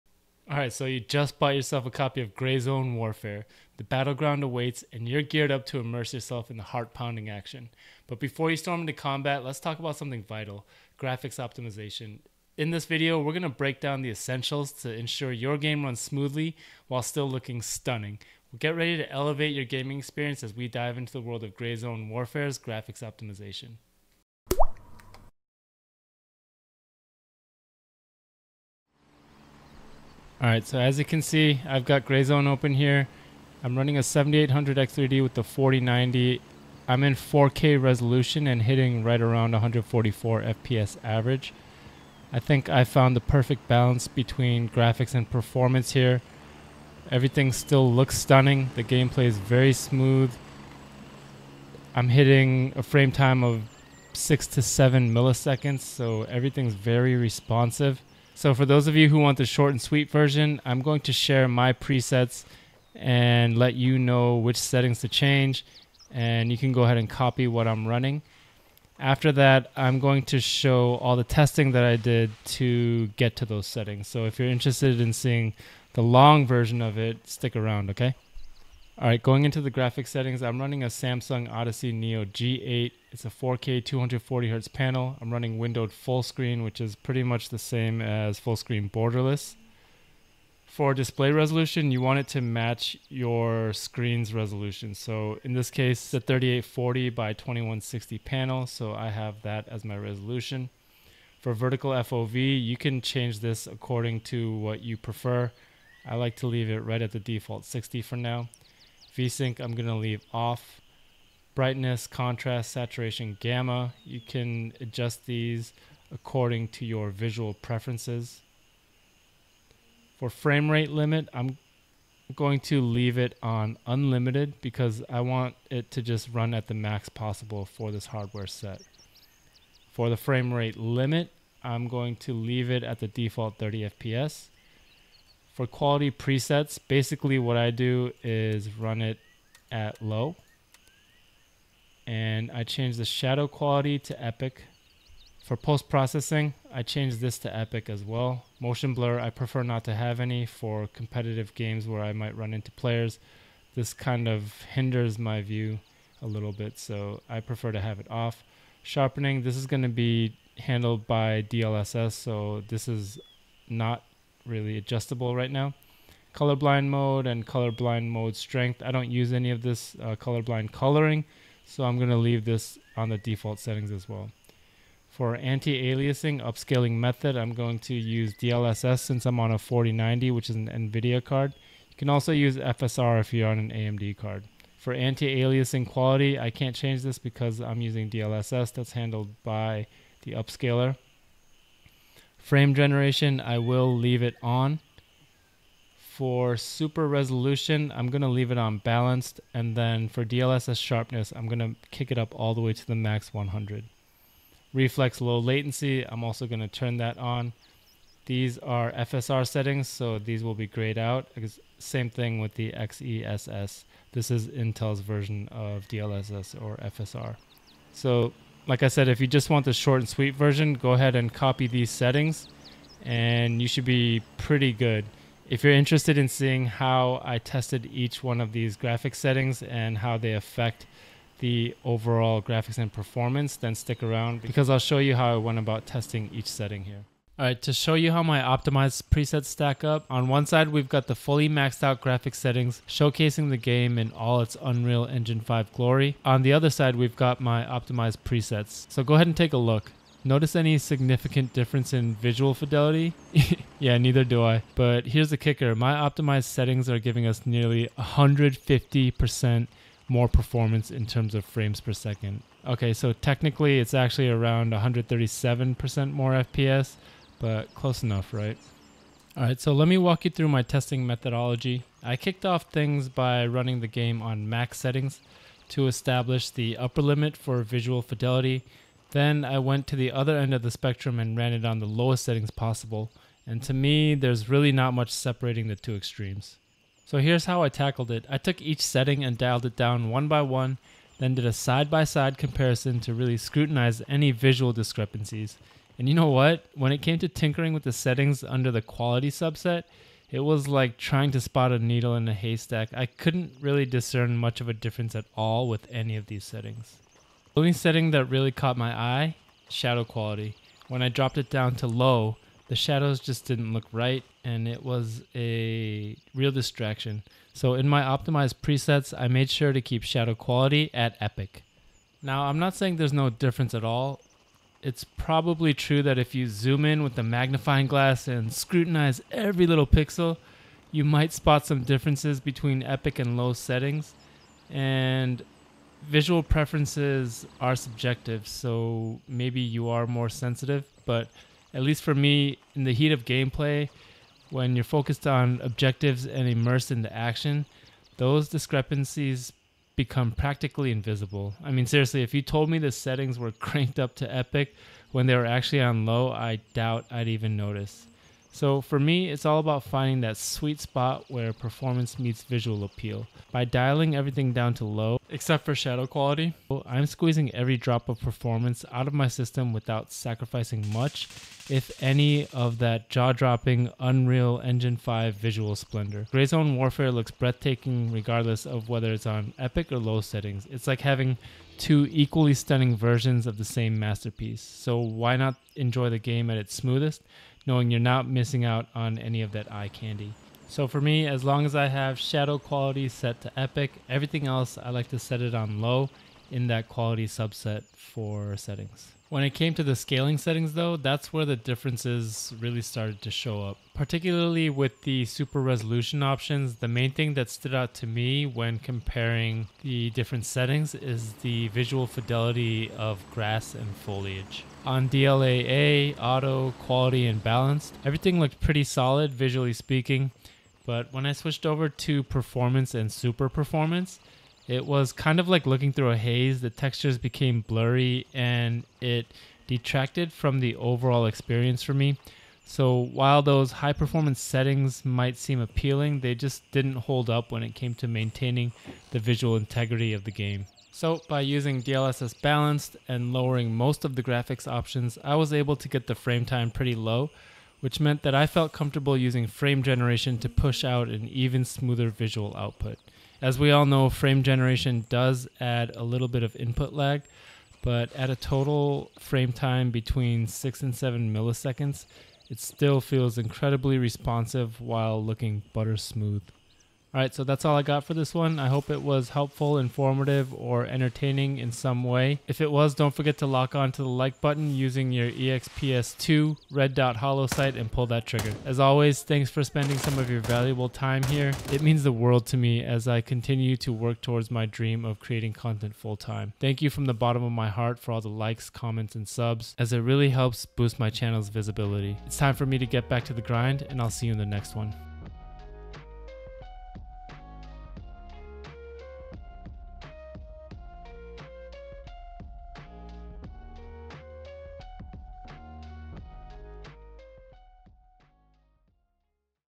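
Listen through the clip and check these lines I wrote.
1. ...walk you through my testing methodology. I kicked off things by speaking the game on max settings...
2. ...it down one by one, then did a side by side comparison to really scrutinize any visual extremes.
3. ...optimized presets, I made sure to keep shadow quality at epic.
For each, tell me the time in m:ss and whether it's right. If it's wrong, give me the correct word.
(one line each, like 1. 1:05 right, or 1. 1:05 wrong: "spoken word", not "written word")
1. 4:29 wrong: "running", not "speaking"
2. 4:49 wrong: "discrepancies", not "extremes"
3. 5:18 right.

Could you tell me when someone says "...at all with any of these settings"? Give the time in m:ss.
5:05.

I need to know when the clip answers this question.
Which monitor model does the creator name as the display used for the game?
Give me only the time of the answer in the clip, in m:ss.
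1:20.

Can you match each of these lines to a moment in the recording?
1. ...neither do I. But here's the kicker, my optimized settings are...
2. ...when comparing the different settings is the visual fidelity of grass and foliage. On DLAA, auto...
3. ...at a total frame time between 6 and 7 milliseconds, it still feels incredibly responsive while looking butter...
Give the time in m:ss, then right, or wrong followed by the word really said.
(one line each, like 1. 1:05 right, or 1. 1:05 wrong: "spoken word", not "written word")
1. 4:13 right
2. 6:48 right
3. 7:38 right.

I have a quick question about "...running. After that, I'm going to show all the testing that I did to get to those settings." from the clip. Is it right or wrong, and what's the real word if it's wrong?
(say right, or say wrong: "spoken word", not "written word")
right.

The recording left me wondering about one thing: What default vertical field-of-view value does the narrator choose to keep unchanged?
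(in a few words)
60.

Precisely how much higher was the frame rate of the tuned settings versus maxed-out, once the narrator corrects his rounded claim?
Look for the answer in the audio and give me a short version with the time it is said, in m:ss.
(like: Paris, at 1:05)
137%, at 4:24.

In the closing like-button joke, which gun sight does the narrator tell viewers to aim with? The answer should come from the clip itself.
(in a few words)
EXPS2 red dot hollow sight.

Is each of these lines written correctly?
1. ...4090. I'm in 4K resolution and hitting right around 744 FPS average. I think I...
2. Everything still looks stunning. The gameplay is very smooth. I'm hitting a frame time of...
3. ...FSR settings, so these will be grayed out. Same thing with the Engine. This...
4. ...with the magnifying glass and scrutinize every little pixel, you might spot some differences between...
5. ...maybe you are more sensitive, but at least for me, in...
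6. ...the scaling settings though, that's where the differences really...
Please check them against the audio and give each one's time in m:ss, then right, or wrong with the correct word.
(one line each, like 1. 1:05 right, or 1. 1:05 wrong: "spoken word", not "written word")
1. 0:35 wrong: "144", not "744"
2. 0:47 right
3. 3:28 wrong: "XESS", not "Engine"
4. 5:27 right
5. 5:39 right
6. 6:39 right.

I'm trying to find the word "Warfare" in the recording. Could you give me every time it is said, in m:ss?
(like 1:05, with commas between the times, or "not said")
0:02, 0:22, 6:16.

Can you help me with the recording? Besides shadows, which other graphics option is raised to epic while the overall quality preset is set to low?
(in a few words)
Post-processing.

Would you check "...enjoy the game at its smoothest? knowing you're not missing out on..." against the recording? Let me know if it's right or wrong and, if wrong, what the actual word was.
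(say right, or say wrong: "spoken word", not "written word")
right.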